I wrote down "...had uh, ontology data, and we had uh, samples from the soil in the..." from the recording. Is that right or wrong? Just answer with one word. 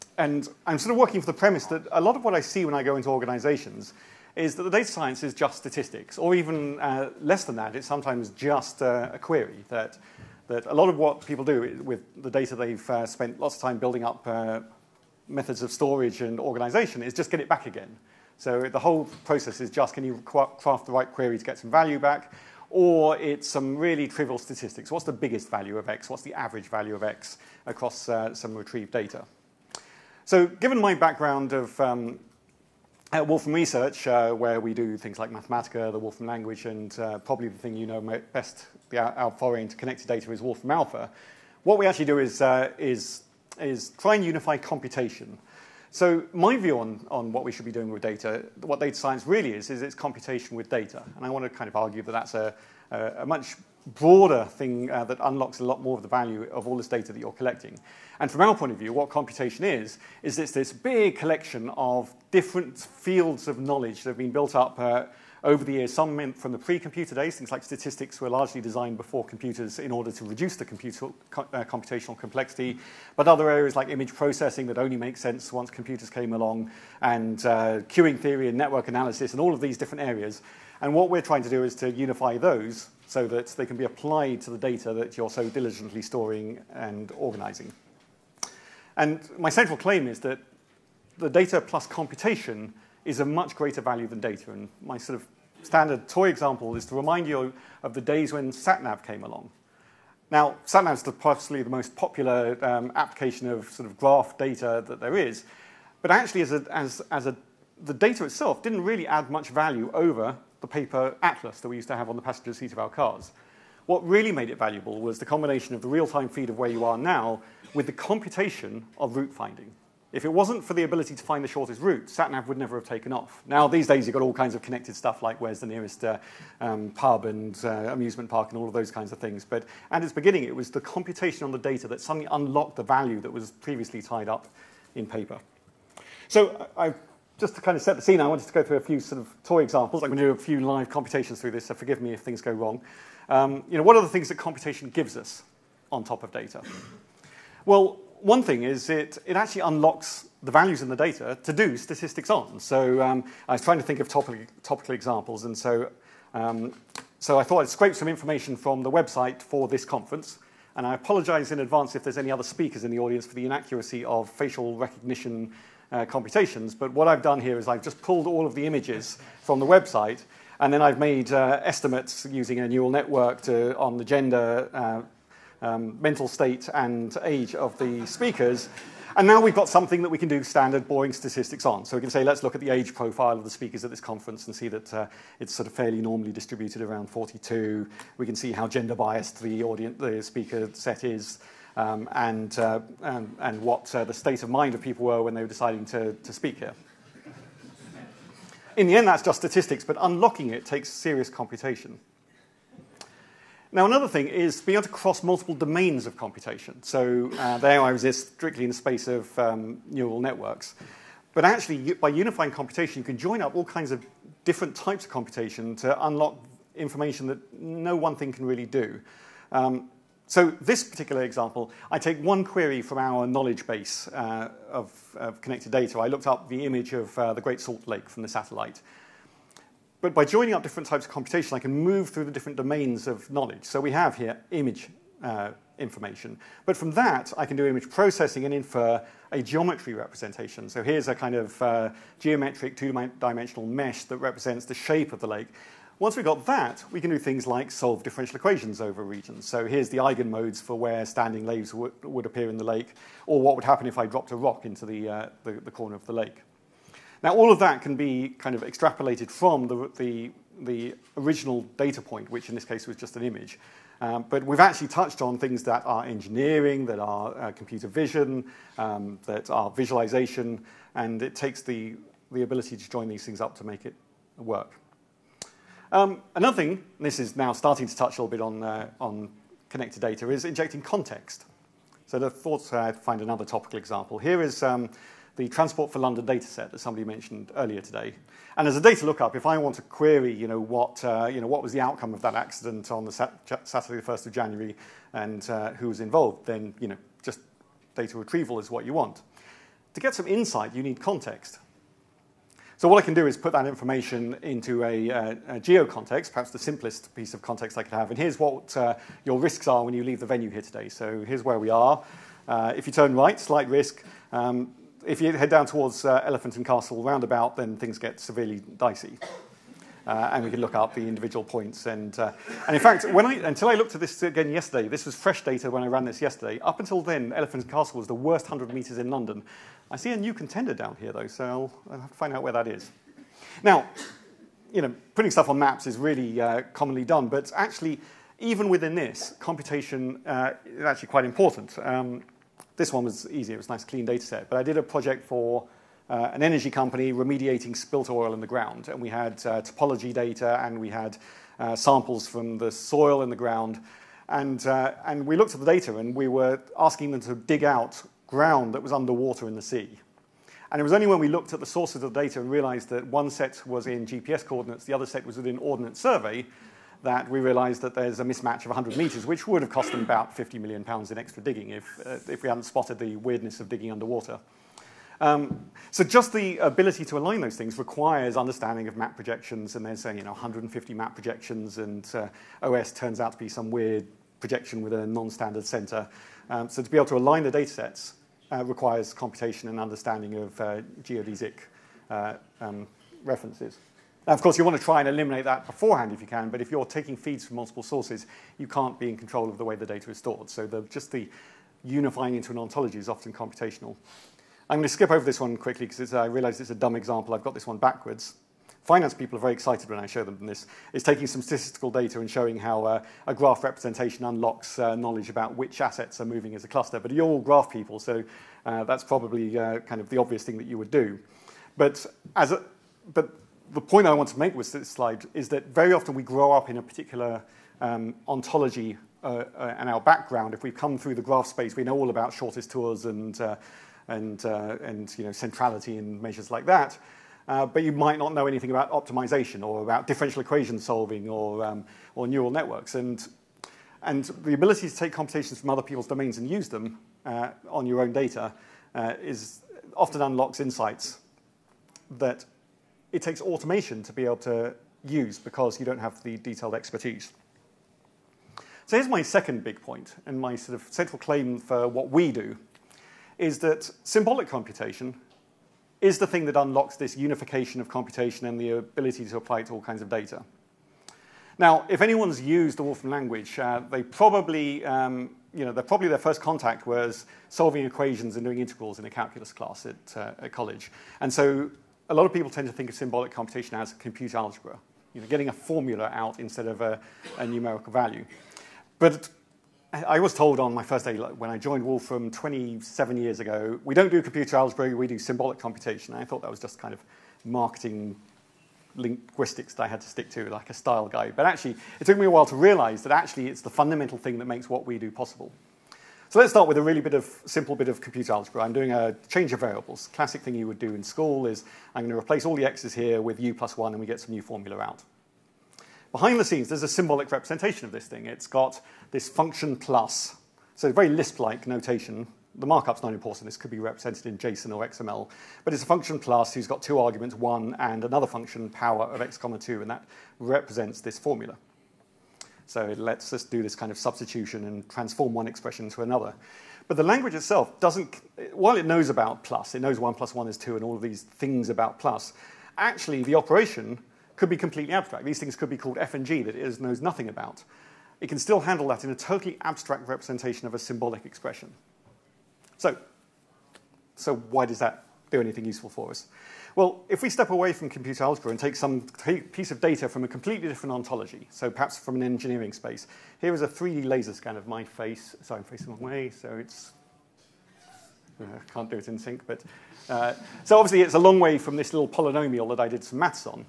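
wrong.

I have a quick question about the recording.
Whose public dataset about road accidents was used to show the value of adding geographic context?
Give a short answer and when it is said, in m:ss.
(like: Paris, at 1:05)
Transport for London, at 4:45.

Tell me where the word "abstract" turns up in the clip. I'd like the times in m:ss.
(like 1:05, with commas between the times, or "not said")
9:04, 9:09.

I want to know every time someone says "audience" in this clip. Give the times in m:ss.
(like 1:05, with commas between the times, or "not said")
2:42, 3:09.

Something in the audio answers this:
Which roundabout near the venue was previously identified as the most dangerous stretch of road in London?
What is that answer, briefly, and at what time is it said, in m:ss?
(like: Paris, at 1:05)
Elephant and Castle, at 5:16.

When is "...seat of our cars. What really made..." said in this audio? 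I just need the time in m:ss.
1:52.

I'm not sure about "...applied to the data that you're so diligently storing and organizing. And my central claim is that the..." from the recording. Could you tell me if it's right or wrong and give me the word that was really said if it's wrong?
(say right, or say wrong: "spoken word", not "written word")
right.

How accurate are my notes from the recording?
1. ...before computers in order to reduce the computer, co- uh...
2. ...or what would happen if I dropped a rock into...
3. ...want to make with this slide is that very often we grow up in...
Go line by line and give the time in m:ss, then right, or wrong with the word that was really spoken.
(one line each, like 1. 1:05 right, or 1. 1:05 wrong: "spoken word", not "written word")
1. 1:08 right
2. 4:13 right
3. 7:04 right.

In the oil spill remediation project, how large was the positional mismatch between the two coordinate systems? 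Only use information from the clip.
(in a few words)
100 meters.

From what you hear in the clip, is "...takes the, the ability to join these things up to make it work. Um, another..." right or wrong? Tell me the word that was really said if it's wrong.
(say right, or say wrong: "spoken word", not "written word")
right.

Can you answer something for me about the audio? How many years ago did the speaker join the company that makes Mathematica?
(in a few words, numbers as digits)
27.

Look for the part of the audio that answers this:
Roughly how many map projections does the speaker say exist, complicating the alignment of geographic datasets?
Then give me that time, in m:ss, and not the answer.
6:20.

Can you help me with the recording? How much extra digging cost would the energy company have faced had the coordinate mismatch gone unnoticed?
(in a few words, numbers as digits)
50 million pounds.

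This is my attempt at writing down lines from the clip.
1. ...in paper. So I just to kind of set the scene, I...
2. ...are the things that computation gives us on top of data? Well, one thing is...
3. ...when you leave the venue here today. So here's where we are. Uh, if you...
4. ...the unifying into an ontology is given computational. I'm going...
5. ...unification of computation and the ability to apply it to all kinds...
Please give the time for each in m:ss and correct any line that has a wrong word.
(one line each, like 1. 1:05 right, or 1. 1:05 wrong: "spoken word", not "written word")
1. 2:14 right
2. 2:23 right
3. 5:09 right
4. 6:41 wrong: "often", not "given"
5. 7:47 right.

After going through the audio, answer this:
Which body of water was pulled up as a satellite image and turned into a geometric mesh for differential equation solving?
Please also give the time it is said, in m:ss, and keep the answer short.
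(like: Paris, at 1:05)
Great Salt Lake, at 3:47.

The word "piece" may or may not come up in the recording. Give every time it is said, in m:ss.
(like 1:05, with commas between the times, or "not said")
5:07, 9:19.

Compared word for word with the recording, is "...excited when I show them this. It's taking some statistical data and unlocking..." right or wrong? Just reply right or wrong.
wrong.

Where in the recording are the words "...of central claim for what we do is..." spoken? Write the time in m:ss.
7:40.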